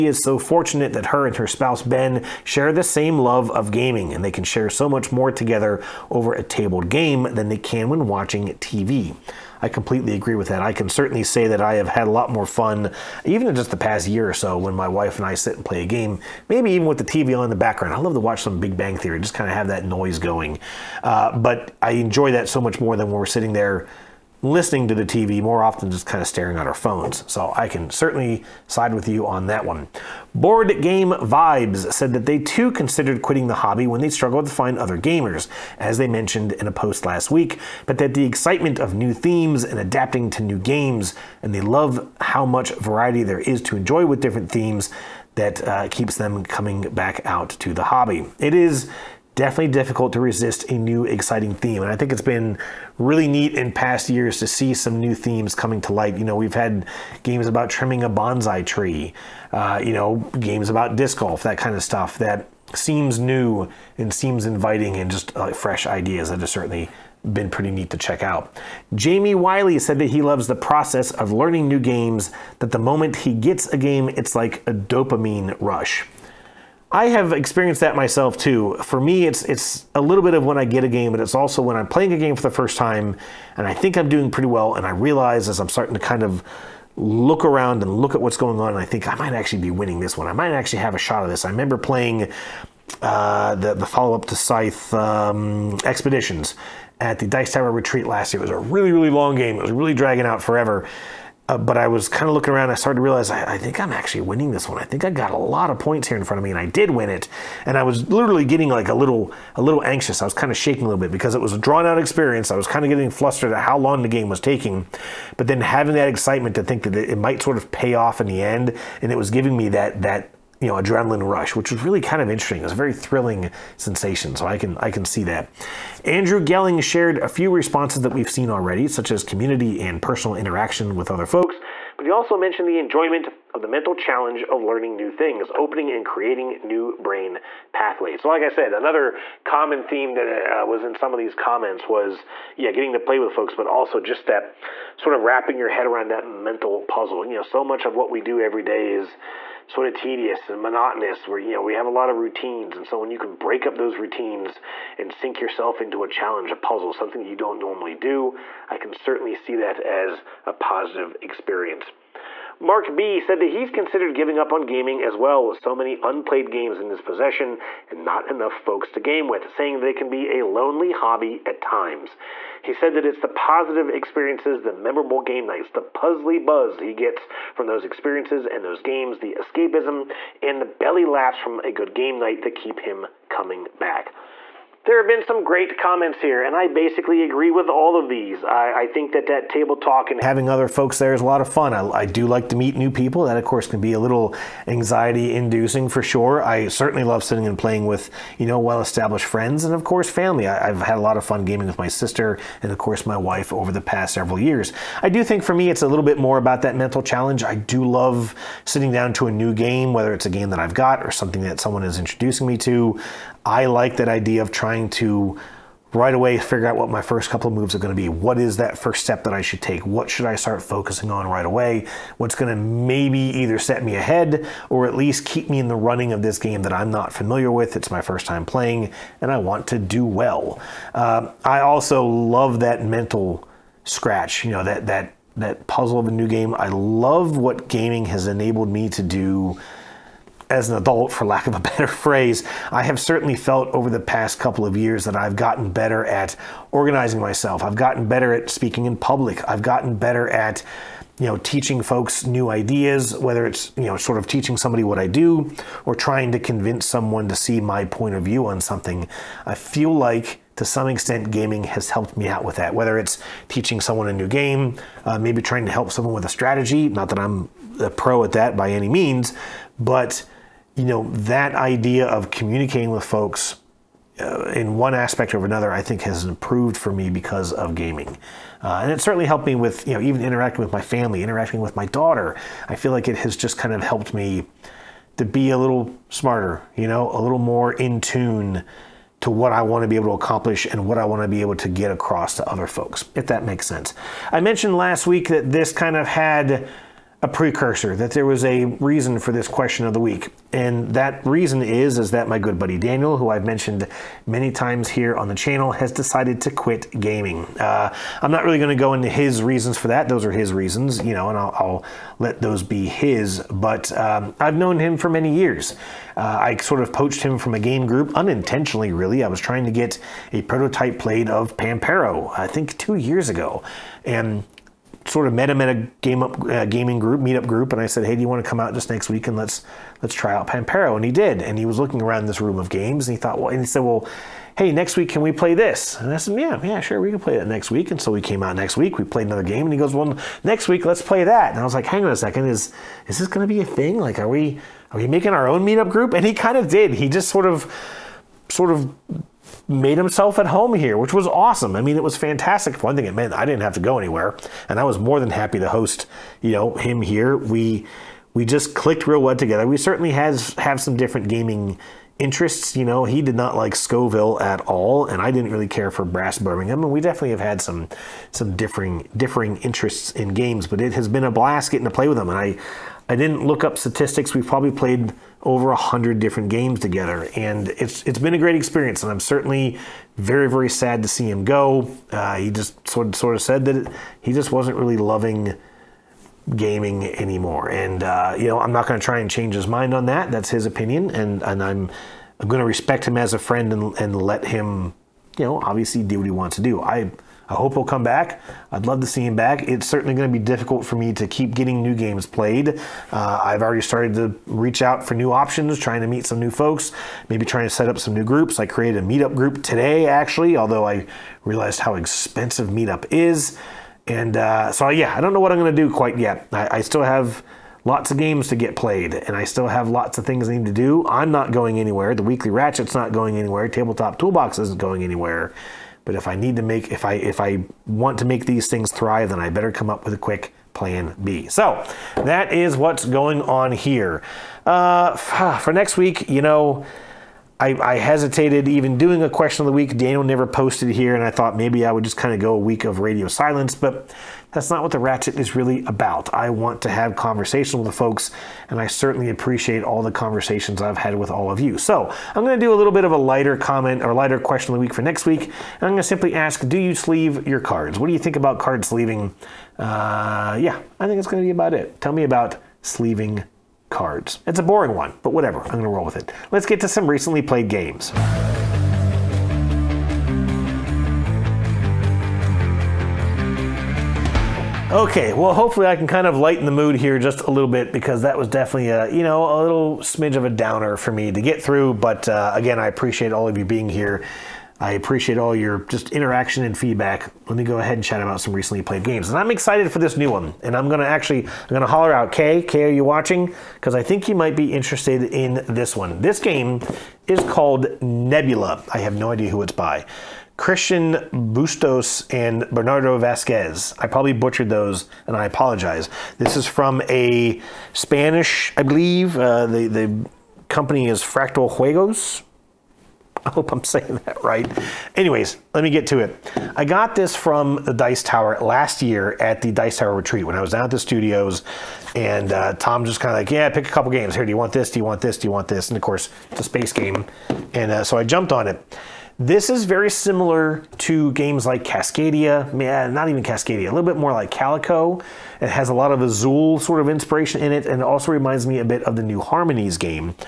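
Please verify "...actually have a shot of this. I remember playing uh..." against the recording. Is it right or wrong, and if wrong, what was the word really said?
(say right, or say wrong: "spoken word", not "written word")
right.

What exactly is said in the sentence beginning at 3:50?
Uh, I also love that mental scratch, you know, that, that, that puzzle of a new game.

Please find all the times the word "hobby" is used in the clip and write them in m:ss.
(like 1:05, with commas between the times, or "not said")
0:33, 0:47, 2:50.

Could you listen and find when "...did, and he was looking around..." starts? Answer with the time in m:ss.
5:31.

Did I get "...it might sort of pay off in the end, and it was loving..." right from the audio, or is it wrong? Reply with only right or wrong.
wrong.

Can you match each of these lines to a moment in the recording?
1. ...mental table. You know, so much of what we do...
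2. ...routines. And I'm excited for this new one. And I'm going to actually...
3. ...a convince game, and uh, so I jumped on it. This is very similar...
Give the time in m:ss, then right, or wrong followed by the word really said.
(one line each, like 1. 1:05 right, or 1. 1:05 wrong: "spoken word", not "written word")
1. 2:26 wrong: "puzzle", not "table"
2. 8:09 wrong: "games", not "routines"
3. 8:46 wrong: "space", not "convince".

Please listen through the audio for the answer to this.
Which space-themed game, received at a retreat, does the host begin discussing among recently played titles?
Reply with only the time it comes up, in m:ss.
8:18.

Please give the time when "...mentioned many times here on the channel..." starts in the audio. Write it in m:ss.
5:03.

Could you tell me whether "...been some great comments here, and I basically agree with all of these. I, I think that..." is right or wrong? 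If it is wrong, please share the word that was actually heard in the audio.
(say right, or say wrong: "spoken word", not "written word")
right.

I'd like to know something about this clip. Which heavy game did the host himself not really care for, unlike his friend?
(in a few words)
Brass Birmingham.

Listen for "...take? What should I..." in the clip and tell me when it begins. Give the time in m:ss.
3:39.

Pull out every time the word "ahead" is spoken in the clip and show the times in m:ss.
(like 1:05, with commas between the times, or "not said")
3:43, 8:07.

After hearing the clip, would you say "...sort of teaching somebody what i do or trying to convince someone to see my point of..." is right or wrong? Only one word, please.
right.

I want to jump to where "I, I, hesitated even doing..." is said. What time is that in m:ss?
7:17.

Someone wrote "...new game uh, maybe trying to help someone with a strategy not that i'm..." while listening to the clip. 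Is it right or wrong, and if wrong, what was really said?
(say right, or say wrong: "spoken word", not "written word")
right.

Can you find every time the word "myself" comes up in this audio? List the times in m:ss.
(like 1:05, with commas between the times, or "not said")
1:17, 4:07.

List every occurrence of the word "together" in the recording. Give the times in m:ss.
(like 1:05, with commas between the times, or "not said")
0:05, 5:59, 6:16.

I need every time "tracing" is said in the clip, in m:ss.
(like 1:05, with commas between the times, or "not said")
not said.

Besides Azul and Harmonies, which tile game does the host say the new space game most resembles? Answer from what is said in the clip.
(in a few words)
Calico.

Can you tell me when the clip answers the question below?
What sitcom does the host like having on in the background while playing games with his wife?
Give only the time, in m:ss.
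0:18.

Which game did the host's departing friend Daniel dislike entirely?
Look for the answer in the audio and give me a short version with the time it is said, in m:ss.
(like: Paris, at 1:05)
Scoville, at 6:03.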